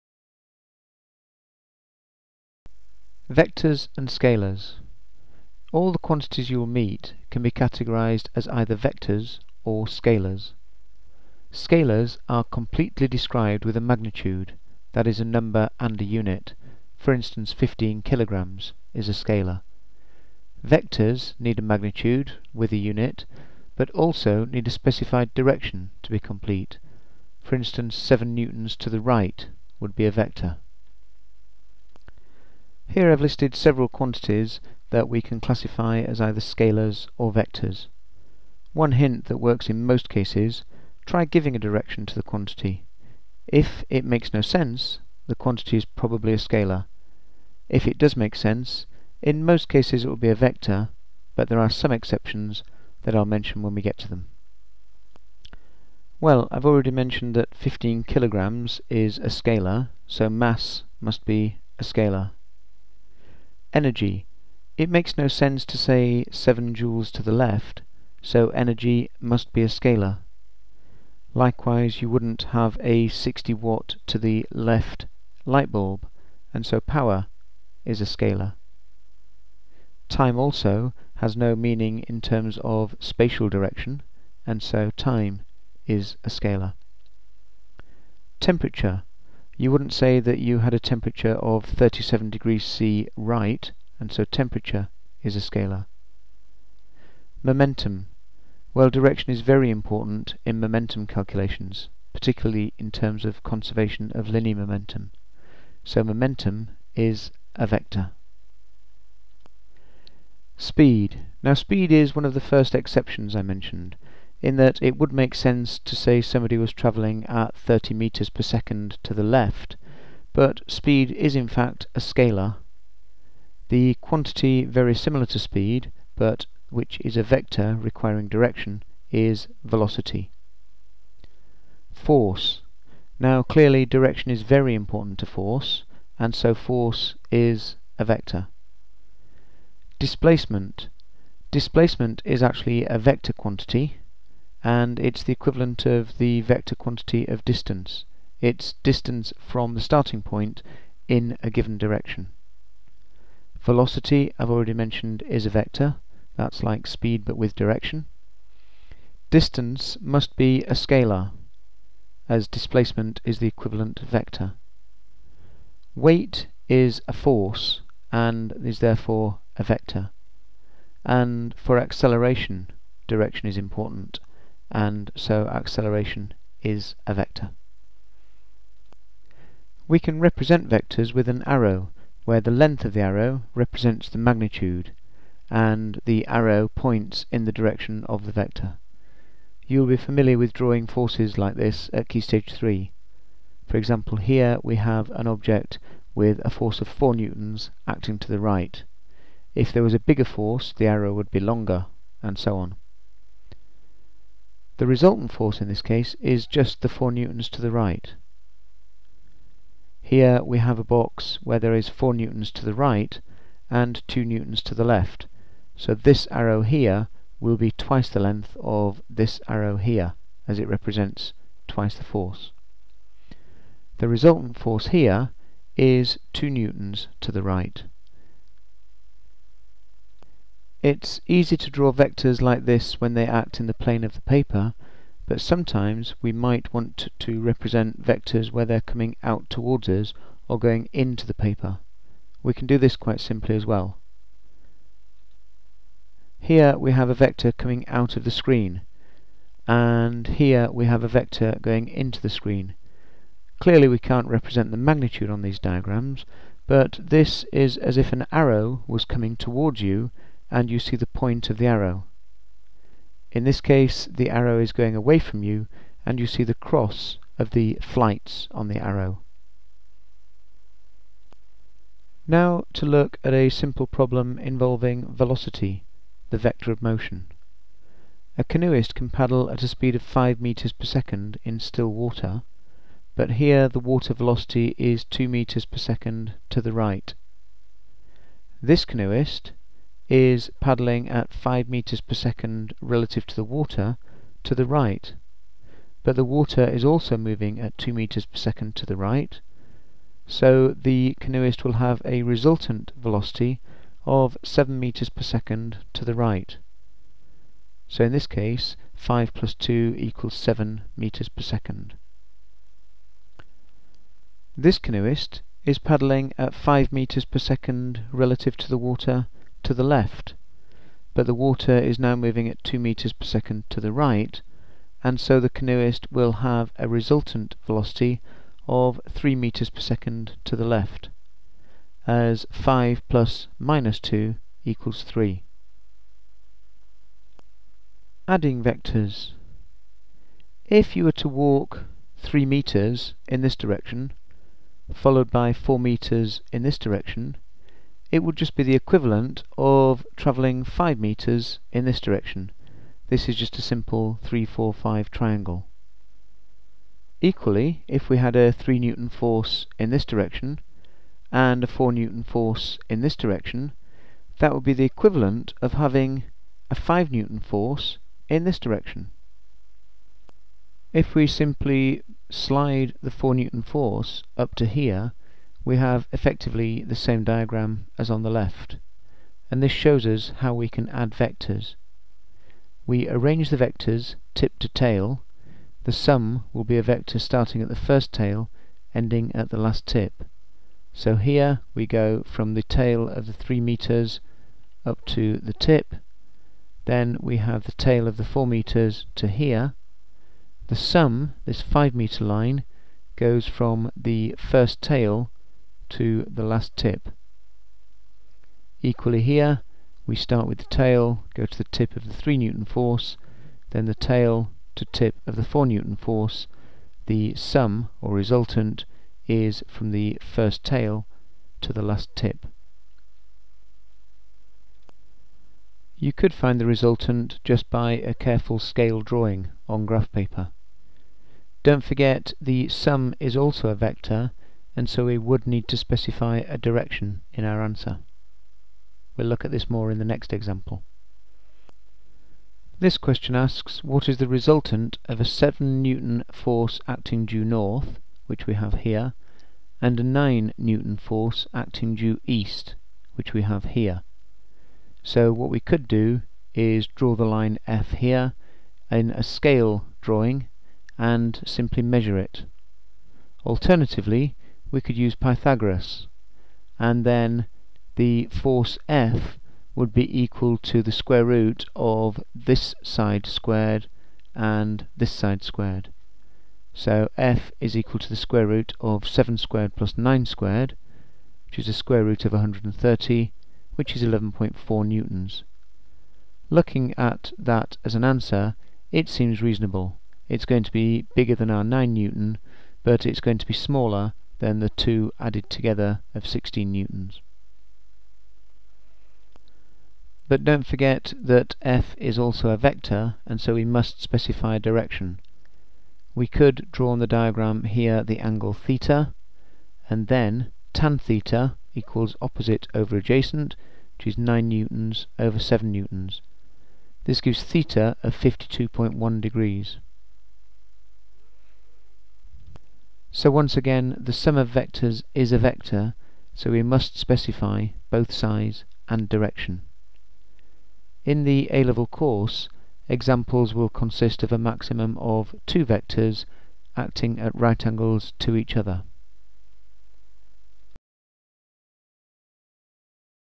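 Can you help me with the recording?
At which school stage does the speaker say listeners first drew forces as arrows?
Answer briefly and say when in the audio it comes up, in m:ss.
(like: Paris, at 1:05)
key stage 3, at 3:12.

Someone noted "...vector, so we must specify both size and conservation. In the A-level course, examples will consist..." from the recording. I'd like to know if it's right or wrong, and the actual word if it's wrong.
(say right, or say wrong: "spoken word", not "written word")
wrong: "direction", not "conservation".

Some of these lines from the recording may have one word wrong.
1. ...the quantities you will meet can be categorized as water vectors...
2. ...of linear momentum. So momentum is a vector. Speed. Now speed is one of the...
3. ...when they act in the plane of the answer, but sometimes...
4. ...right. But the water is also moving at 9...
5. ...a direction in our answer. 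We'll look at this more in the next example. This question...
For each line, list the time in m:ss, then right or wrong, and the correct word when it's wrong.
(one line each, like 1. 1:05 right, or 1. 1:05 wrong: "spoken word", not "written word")
1. 0:05 wrong: "either", not "water"
2. 1:44 right
3. 3:52 wrong: "paper", not "answer"
4. 4:54 wrong: "2", not "9"
5. 7:16 right.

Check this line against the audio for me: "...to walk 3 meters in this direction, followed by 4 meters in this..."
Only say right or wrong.
right.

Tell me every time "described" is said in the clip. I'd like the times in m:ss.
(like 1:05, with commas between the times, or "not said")
0:13.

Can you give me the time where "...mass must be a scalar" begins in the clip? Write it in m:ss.
1:00.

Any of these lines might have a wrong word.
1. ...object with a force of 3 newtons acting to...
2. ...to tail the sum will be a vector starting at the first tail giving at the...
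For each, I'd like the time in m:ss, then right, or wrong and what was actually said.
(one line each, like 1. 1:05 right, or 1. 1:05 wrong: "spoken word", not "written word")
1. 3:15 wrong: "4", not "3"
2. 6:24 wrong: "ending", not "giving".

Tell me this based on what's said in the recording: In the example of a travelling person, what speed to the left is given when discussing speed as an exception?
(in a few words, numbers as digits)
30 meters per second.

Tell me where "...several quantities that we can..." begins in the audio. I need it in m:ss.
0:33.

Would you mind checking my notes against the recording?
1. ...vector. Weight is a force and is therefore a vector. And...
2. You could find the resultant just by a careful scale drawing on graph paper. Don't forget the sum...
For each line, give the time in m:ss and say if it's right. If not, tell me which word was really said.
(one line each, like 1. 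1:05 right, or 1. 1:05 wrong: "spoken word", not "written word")
1. 2:43 right
2. 7:05 right.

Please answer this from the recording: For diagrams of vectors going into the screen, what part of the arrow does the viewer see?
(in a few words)
the cross of the flights.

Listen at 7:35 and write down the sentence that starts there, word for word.
So what we could do is draw the line F here in a scale drawing and simply measure it.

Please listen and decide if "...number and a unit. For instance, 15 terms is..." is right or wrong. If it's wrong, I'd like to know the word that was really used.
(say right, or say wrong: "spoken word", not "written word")
wrong: "kilograms", not "terms".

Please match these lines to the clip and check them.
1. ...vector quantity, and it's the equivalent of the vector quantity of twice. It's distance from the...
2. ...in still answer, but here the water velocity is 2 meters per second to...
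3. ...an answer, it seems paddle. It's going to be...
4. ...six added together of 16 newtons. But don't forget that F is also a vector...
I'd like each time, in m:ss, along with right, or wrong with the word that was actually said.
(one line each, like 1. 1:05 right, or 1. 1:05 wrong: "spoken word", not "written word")
1. 2:22 wrong: "distance", not "twice"
2. 4:41 wrong: "water", not "answer"
3. 8:07 wrong: "reasonable", not "paddle"
4. 8:14 wrong: "two", not "six".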